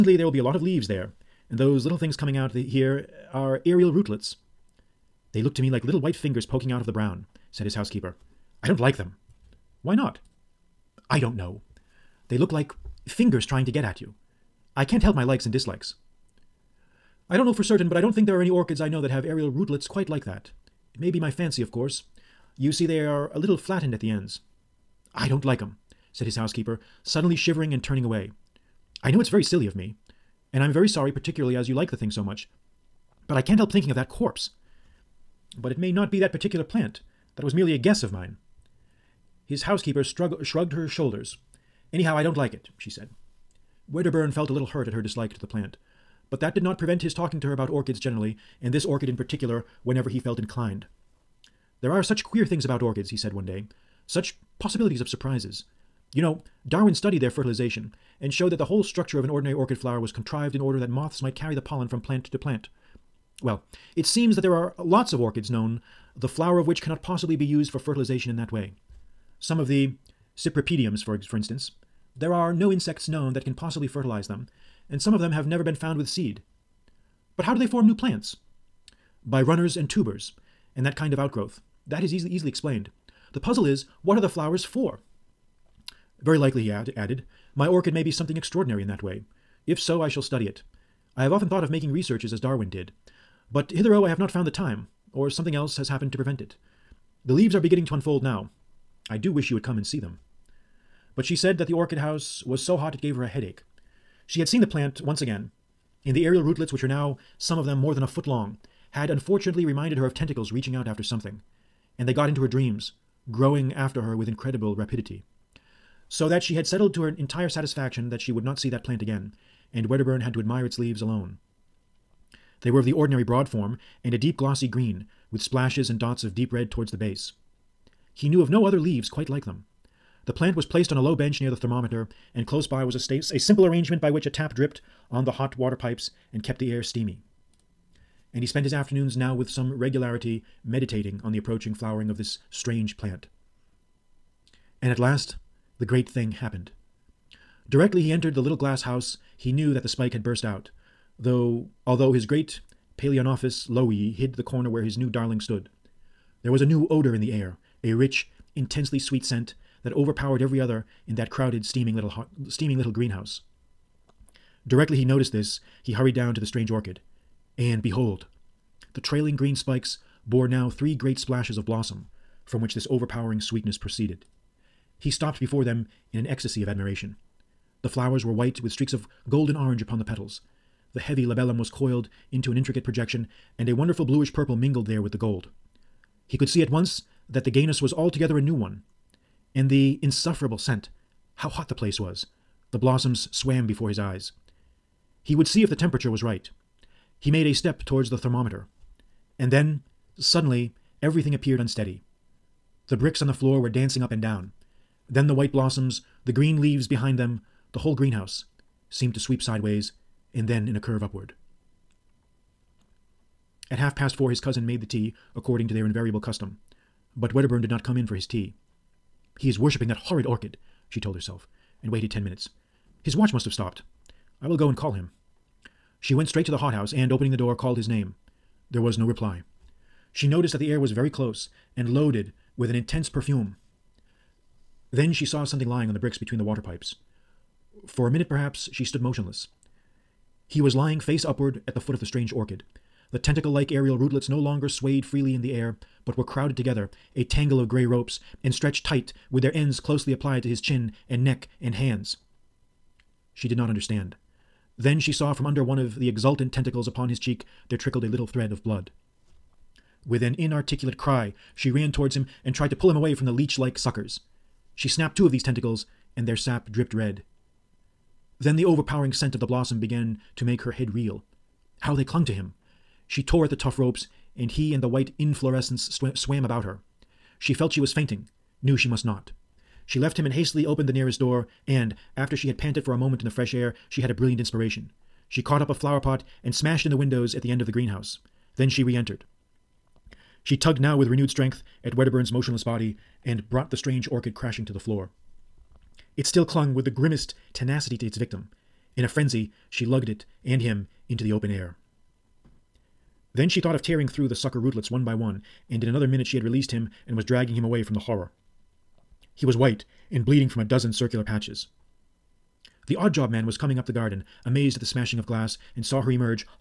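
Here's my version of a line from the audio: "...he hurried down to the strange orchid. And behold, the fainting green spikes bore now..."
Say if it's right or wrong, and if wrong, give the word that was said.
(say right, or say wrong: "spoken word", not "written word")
wrong: "trailing", not "fainting".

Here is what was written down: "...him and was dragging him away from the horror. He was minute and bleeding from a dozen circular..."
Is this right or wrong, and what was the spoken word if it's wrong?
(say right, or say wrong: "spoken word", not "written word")
wrong: "white", not "minute".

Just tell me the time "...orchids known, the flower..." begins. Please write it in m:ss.
1:05.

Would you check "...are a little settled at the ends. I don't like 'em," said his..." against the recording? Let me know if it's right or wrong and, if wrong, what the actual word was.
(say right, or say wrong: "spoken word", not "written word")
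wrong: "flattened", not "settled".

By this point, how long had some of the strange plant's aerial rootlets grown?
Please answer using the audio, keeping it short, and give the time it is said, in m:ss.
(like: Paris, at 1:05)
more than a foot, at 1:47.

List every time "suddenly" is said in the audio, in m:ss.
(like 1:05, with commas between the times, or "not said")
0:27, 3:20.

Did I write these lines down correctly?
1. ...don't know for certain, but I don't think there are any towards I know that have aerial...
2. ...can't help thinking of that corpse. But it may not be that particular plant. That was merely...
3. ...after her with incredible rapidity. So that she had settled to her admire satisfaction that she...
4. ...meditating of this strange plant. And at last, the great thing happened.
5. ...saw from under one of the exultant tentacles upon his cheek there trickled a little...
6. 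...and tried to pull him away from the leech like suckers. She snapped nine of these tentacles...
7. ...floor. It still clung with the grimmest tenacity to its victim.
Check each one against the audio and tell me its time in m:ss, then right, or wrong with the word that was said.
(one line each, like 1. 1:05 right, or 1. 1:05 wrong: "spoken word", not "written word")
1. 0:17 wrong: "orchids", not "towards"
2. 0:33 right
3. 1:53 wrong: "entire", not "admire"
4. 2:21 wrong: "flowering", not "meditating"
5. 4:15 right
6. 4:22 wrong: "two", not "nine"
7. 4:54 right.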